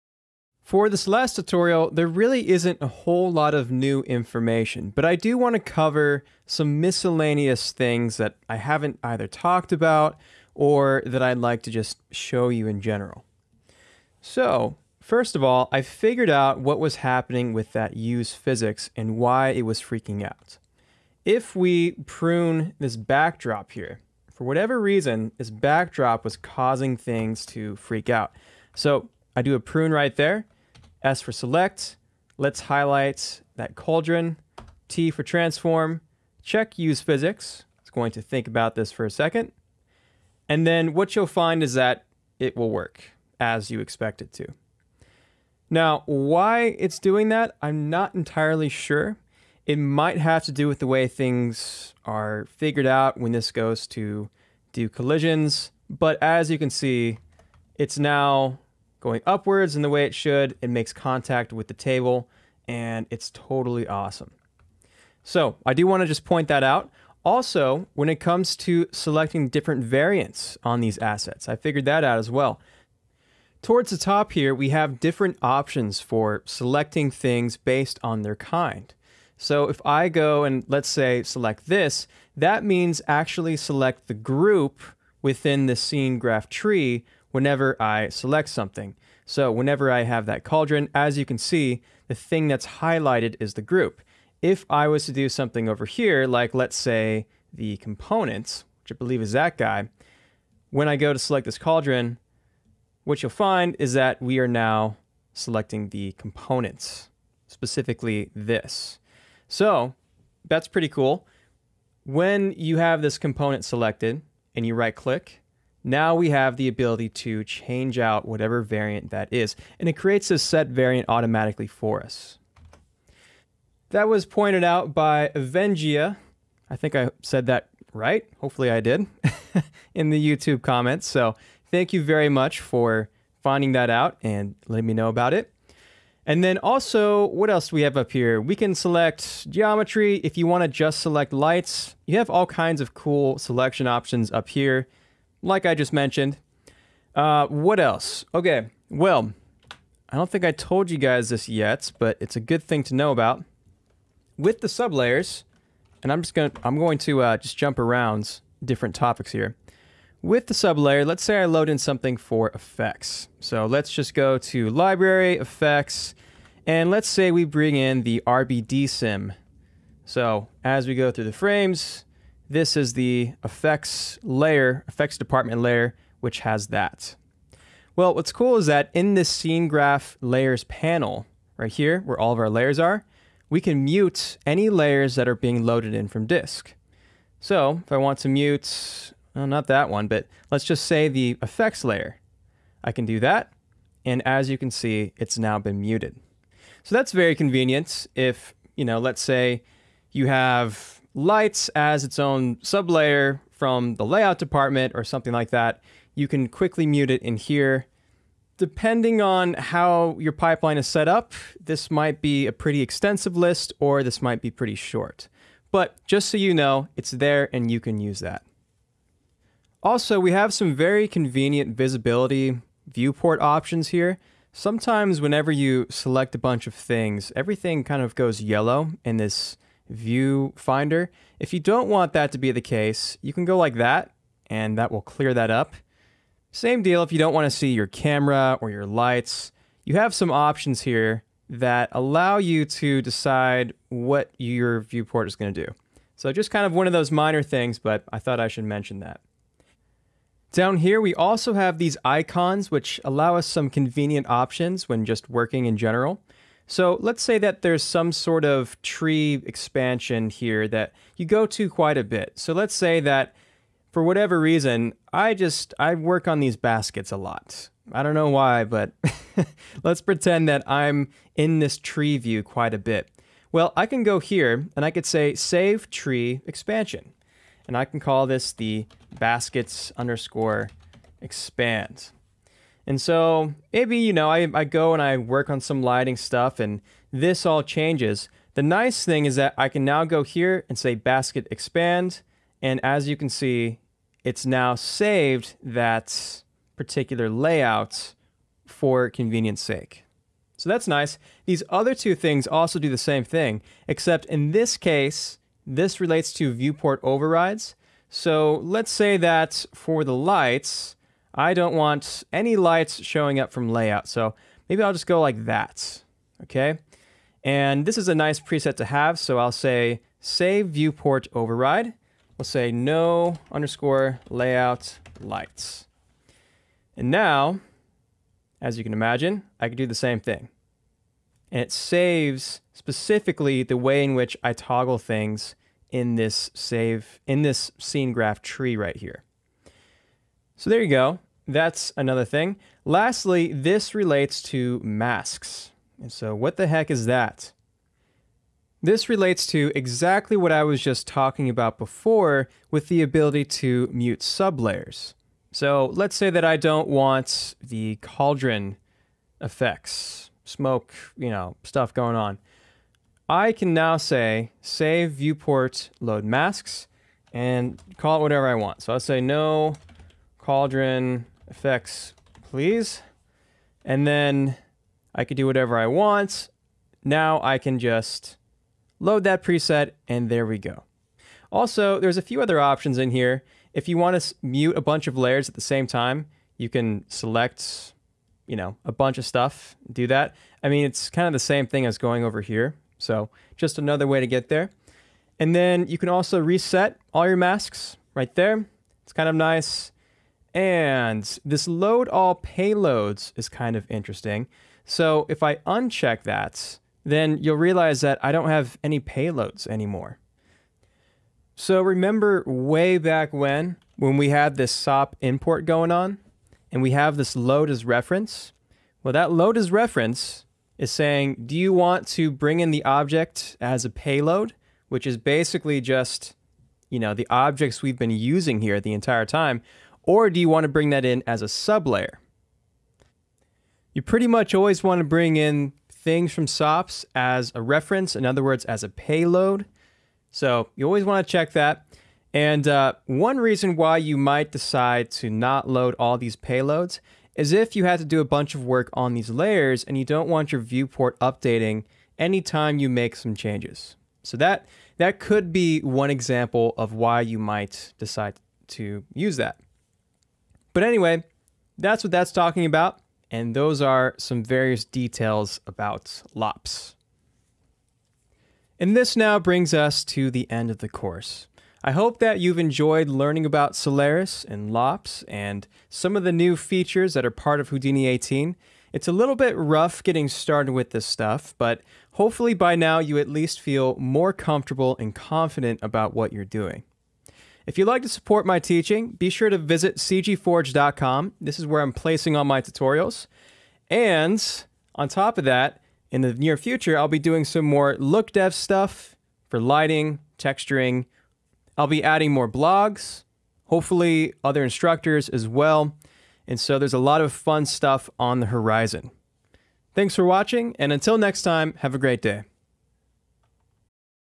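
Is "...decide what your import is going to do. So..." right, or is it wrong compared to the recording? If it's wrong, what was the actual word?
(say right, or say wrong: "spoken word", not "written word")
wrong: "viewport", not "import".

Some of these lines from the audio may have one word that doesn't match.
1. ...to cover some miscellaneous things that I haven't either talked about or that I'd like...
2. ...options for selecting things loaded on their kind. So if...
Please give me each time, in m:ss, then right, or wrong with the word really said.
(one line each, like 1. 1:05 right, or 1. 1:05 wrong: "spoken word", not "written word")
1. 0:05 right
2. 1:15 wrong: "based", not "loaded".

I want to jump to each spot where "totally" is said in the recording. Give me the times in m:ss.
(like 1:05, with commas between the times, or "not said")
1:03.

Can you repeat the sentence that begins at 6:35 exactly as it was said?
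And then you can also reset all your masks right there.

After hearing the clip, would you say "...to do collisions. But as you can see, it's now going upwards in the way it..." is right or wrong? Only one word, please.
right.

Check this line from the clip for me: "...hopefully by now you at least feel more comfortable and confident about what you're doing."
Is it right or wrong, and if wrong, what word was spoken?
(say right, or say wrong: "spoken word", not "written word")
right.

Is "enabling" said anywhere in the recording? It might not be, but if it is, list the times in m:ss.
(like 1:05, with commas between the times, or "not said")
not said.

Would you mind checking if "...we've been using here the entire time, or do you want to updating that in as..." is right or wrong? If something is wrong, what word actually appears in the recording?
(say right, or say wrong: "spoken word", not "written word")
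wrong: "bring", not "updating".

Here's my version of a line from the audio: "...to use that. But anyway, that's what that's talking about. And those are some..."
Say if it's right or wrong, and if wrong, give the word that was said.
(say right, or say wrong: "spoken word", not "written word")
right.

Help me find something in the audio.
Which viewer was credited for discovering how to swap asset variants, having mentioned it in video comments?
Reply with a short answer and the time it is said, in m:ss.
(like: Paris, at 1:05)
Avengia, at 2:05.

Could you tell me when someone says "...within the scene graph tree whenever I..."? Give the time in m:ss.
1:25.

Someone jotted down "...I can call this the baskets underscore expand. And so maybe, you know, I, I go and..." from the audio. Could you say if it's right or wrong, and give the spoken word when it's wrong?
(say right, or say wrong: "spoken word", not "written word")
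right.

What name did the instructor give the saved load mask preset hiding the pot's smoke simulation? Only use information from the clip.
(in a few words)
no cauldron effects, please.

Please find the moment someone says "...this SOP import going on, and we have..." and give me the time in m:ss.
6:54.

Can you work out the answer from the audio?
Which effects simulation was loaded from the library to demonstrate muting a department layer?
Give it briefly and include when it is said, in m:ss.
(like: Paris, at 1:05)
RBD sim, at 2:48.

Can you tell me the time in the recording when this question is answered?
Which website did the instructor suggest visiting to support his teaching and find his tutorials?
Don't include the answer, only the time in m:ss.
8:09.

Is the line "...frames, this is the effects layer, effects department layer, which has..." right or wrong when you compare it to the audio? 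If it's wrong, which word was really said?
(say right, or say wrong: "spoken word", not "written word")
right.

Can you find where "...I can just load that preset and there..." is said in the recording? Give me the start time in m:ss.
6:17.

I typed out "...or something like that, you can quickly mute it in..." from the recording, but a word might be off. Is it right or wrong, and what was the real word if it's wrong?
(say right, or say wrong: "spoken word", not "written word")
right.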